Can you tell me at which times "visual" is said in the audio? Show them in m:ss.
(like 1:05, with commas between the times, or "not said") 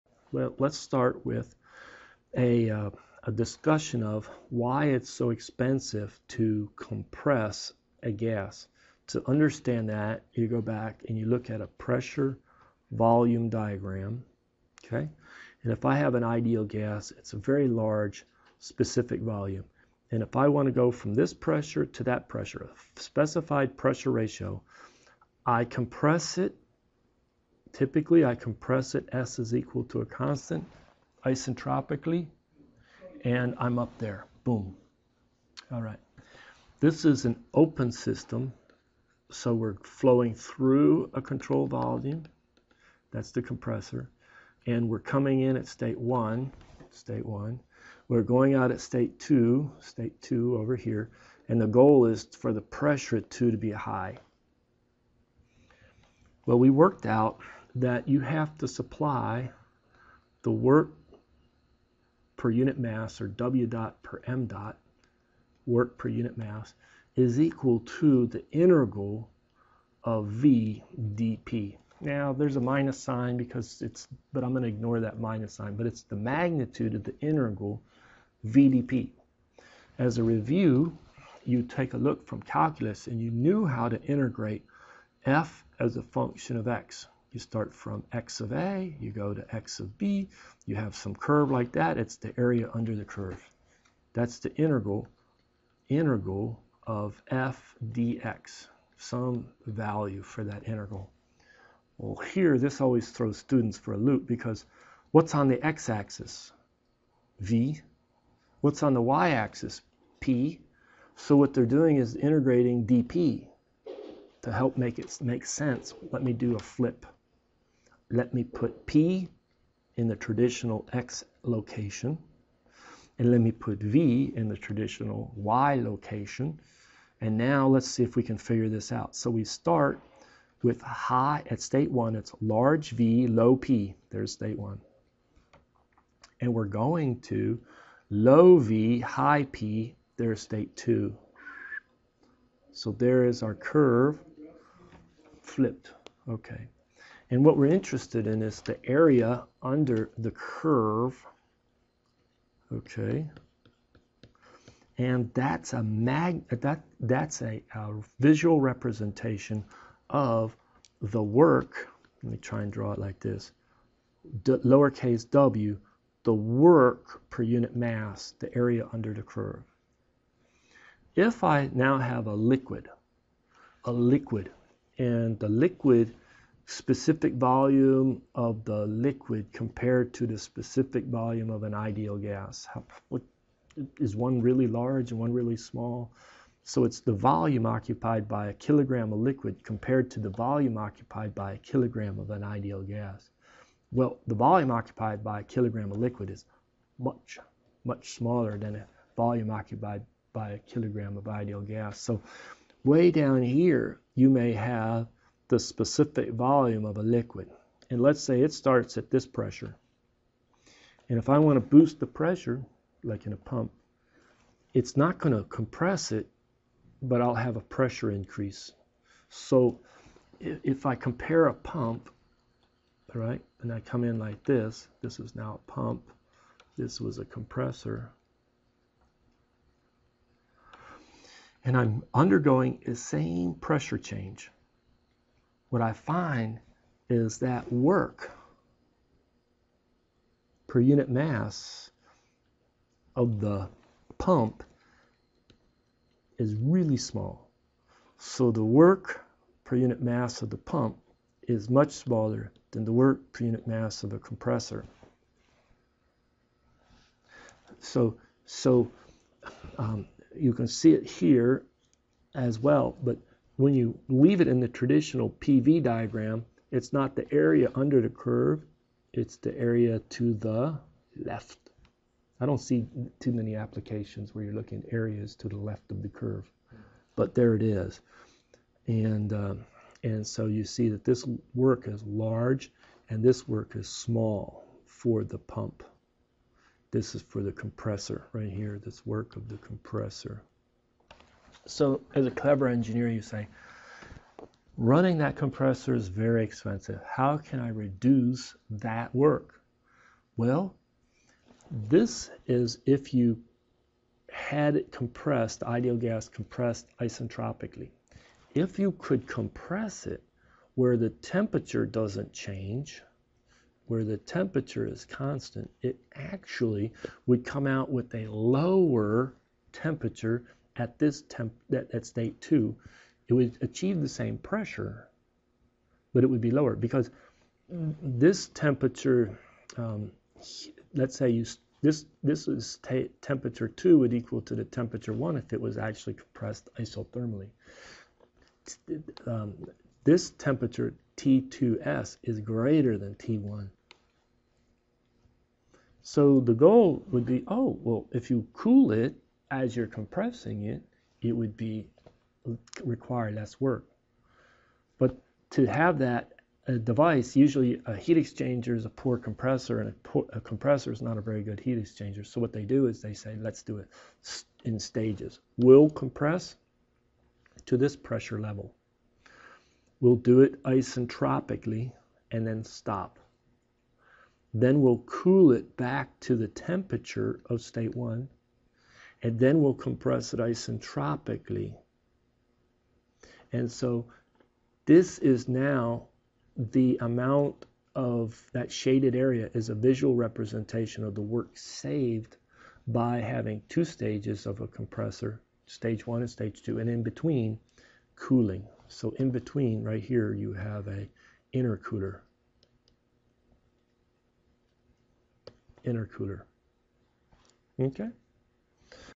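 2:38, 6:29.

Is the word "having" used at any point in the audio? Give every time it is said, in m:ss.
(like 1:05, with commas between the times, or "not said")
6:33.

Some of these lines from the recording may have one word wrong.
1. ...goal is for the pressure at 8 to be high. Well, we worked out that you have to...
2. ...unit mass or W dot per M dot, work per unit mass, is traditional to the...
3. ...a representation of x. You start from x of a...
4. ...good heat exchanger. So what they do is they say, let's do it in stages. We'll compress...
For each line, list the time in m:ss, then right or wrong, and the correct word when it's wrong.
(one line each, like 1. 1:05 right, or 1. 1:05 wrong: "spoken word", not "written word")
1. 0:51 wrong: "2", not "8"
2. 1:02 wrong: "equal", not "traditional"
3. 1:25 wrong: "function", not "representation"
4. 6:01 right.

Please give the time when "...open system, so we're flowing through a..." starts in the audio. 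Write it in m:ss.
0:37.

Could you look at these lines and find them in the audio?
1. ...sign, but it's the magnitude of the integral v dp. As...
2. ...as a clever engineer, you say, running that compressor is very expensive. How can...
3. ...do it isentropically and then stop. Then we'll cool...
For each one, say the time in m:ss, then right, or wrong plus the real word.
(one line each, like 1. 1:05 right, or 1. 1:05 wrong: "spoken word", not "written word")
1. 1:15 right
2. 4:52 right
3. 6:10 right.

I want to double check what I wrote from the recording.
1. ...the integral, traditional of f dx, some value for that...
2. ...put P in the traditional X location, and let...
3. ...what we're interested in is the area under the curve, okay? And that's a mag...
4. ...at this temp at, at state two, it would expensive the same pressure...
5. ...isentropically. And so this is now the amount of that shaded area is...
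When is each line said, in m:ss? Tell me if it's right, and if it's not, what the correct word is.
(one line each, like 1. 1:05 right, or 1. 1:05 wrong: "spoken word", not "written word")
1. 1:34 wrong: "integral", not "traditional"
2. 1:58 right
3. 2:27 right
4. 5:20 wrong: "achieve", not "expensive"
5. 6:20 right.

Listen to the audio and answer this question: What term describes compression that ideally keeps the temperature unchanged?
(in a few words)
isothermally.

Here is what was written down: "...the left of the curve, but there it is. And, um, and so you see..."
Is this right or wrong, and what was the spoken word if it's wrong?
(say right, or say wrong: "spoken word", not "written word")
right.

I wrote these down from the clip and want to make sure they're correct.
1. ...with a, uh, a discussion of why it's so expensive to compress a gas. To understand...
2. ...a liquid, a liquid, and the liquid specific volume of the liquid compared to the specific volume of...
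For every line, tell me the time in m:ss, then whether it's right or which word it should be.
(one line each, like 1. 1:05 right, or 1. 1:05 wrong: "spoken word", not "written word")
1. 0:01 right
2. 2:52 right.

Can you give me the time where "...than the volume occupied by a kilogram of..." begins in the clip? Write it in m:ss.
3:18.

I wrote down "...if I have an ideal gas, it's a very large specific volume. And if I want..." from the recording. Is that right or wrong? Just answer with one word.
right.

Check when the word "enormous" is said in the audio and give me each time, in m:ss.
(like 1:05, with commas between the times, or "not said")
not said.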